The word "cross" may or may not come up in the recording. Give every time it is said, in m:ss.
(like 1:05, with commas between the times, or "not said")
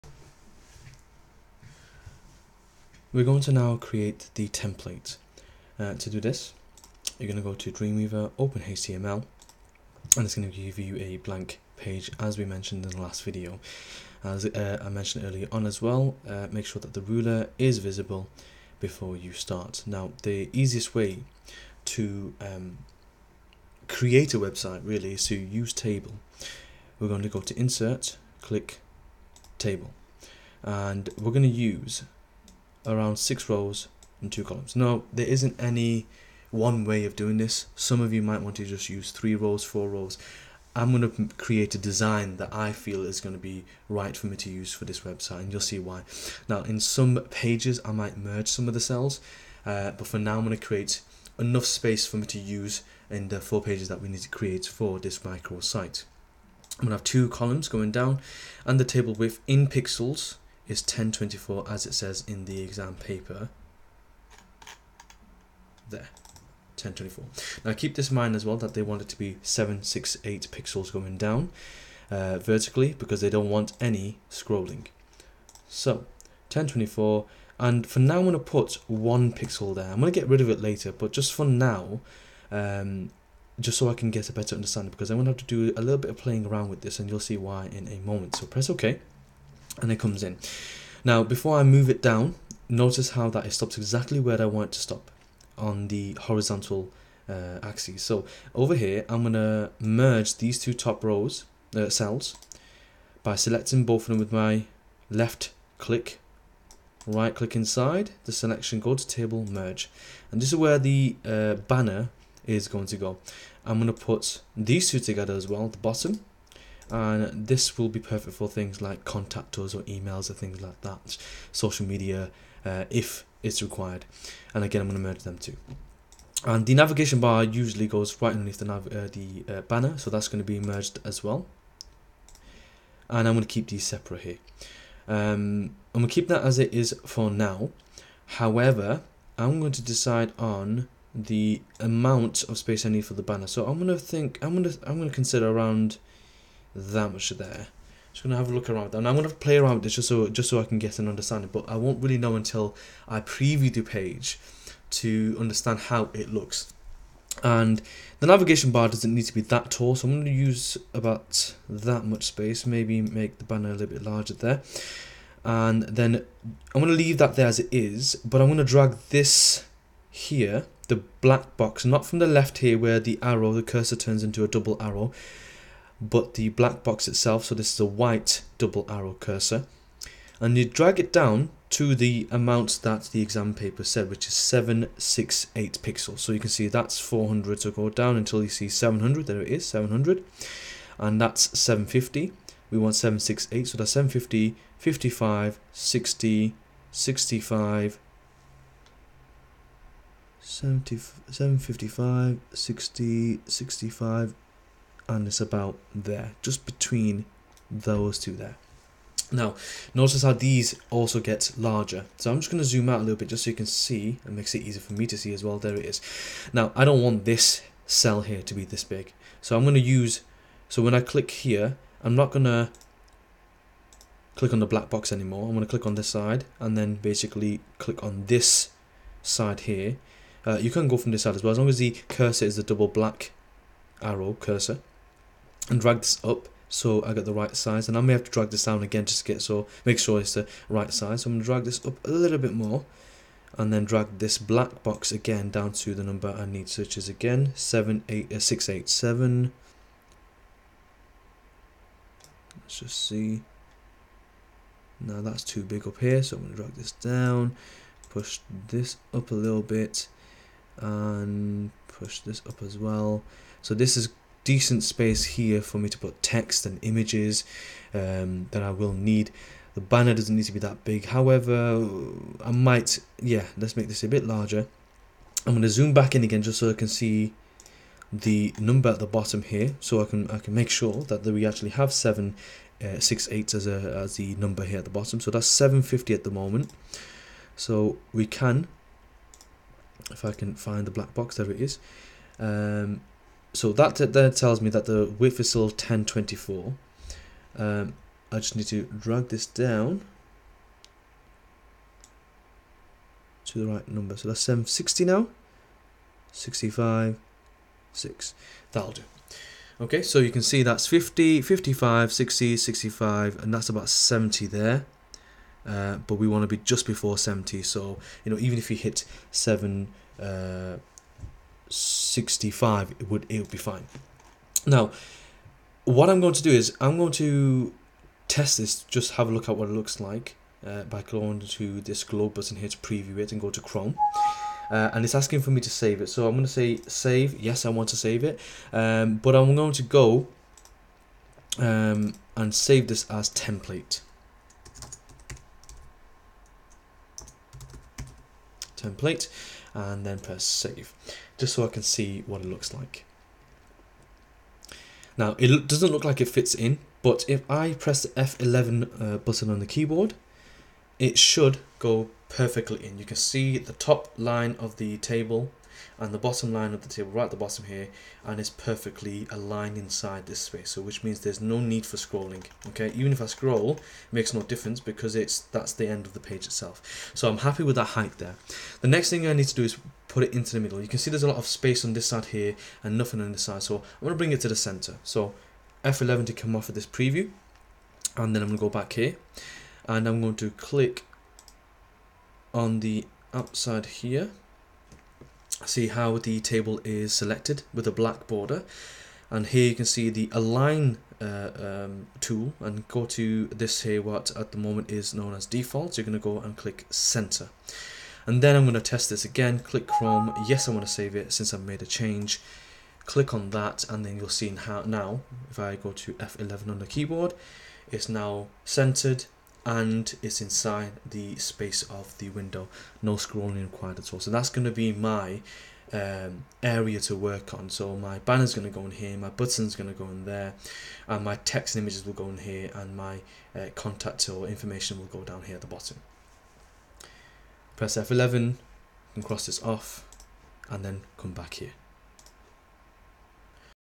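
7:19.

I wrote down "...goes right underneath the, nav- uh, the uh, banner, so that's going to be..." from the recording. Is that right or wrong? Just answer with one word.
right.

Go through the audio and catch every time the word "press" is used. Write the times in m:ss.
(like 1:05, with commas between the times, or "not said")
1:28, 5:50, 5:57, 7:17.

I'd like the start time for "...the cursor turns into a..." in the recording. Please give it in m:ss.
2:53.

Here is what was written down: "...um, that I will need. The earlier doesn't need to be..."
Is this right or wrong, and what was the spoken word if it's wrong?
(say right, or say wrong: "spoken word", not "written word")
wrong: "banner", not "earlier".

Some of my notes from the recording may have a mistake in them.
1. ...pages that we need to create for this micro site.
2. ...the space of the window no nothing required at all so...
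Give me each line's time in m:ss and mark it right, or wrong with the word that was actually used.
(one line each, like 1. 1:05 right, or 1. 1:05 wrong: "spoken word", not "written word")
1. 0:53 right
2. 7:01 wrong: "scrolling", not "nothing".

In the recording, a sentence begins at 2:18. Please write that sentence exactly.
However, I'm going to decide on the amount of space I need for the banner.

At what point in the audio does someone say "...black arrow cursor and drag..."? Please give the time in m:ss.
3:52.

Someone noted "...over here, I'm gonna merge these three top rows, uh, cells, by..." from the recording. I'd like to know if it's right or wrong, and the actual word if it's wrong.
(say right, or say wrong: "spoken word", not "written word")
wrong: "two", not "three".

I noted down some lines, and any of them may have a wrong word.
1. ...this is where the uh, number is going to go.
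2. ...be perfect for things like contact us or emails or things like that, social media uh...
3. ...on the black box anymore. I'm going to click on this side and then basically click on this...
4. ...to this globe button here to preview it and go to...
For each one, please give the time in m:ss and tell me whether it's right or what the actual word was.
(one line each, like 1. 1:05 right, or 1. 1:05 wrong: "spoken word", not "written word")
1. 1:50 wrong: "banner", not "number"
2. 1:57 right
3. 3:44 right
4. 5:31 right.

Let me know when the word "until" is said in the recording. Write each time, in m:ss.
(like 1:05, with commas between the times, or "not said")
2:32, 3:08.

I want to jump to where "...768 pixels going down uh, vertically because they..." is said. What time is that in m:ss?
1:09.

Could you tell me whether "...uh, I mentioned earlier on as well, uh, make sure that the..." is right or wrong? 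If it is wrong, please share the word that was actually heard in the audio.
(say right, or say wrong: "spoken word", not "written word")
right.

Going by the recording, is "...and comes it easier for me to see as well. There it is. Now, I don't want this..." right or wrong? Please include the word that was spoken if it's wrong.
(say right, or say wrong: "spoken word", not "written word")
wrong: "makes", not "comes".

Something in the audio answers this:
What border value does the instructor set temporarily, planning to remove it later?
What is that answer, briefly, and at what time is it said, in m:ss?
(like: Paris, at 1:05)
1 pixel, at 1:18.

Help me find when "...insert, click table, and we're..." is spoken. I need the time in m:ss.
0:27.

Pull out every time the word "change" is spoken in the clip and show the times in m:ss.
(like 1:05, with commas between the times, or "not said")
6:51.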